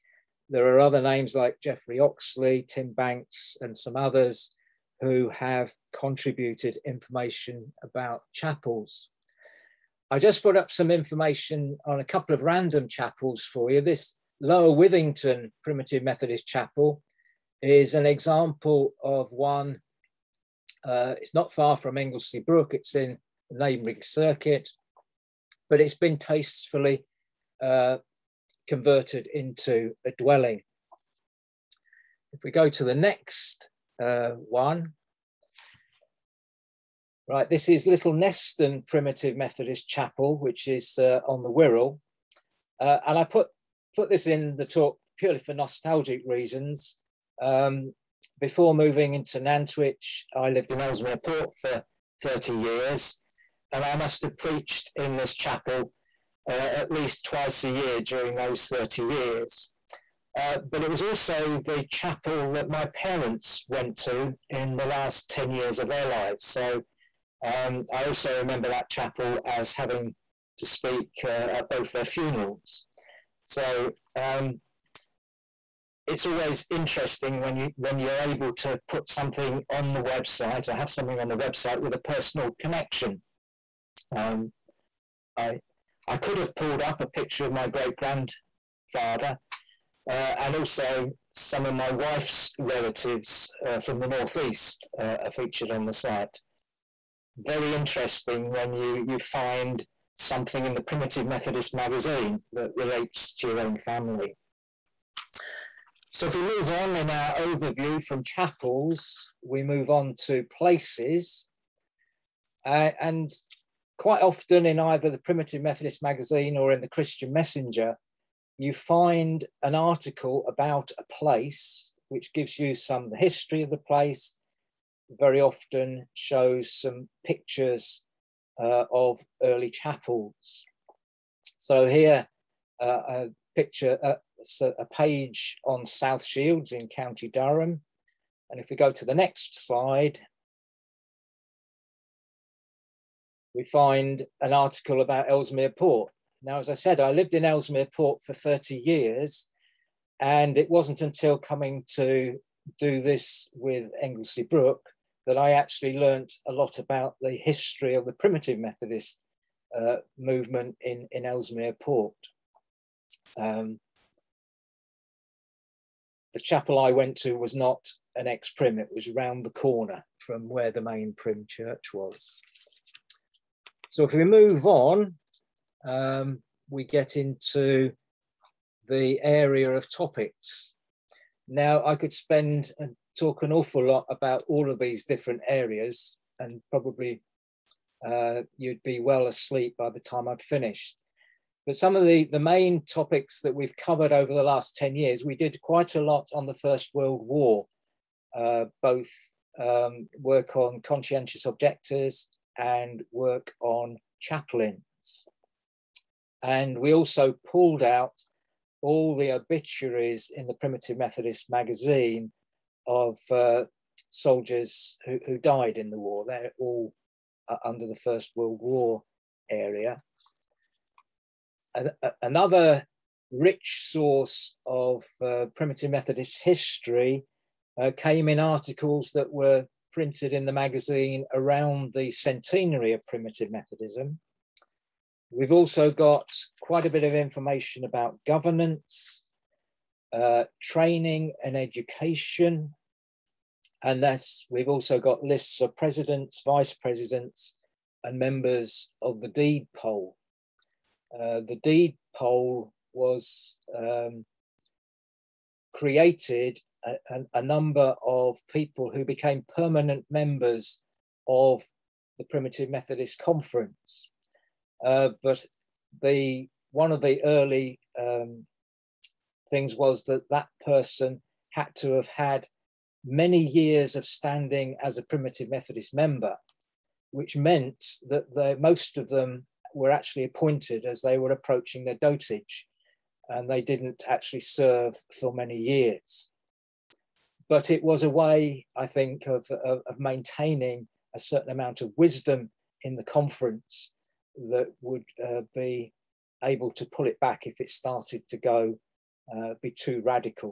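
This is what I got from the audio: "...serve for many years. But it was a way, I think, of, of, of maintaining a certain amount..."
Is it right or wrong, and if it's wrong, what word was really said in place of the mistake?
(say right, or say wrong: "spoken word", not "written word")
right.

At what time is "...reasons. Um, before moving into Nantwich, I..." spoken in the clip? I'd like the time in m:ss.
0:46.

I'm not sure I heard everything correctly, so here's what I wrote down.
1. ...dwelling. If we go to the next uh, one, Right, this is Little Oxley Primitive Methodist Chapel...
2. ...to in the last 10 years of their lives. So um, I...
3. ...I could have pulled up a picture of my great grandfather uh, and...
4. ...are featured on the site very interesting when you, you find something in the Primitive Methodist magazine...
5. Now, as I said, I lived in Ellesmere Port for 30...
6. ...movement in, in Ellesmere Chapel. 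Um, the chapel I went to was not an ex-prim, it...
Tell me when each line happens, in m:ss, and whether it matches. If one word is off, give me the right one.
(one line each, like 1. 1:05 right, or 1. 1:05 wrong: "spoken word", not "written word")
1. 0:30 wrong: "Neston", not "Oxley"
2. 1:04 right
3. 1:26 right
4. 1:35 right
5. 2:26 right
6. 2:40 wrong: "Port", not "Chapel".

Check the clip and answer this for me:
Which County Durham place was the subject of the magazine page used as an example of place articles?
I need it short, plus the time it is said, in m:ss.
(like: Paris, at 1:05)
South Shields, at 2:15.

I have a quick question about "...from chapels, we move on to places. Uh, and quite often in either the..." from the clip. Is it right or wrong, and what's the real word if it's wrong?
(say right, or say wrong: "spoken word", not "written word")
right.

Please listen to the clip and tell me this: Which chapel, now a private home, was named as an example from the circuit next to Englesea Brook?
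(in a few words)
Lower Withington Primitive Methodist Chapel.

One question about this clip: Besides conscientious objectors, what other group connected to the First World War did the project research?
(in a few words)
Chaplains.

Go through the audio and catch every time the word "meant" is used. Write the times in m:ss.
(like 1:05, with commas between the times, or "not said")
4:37.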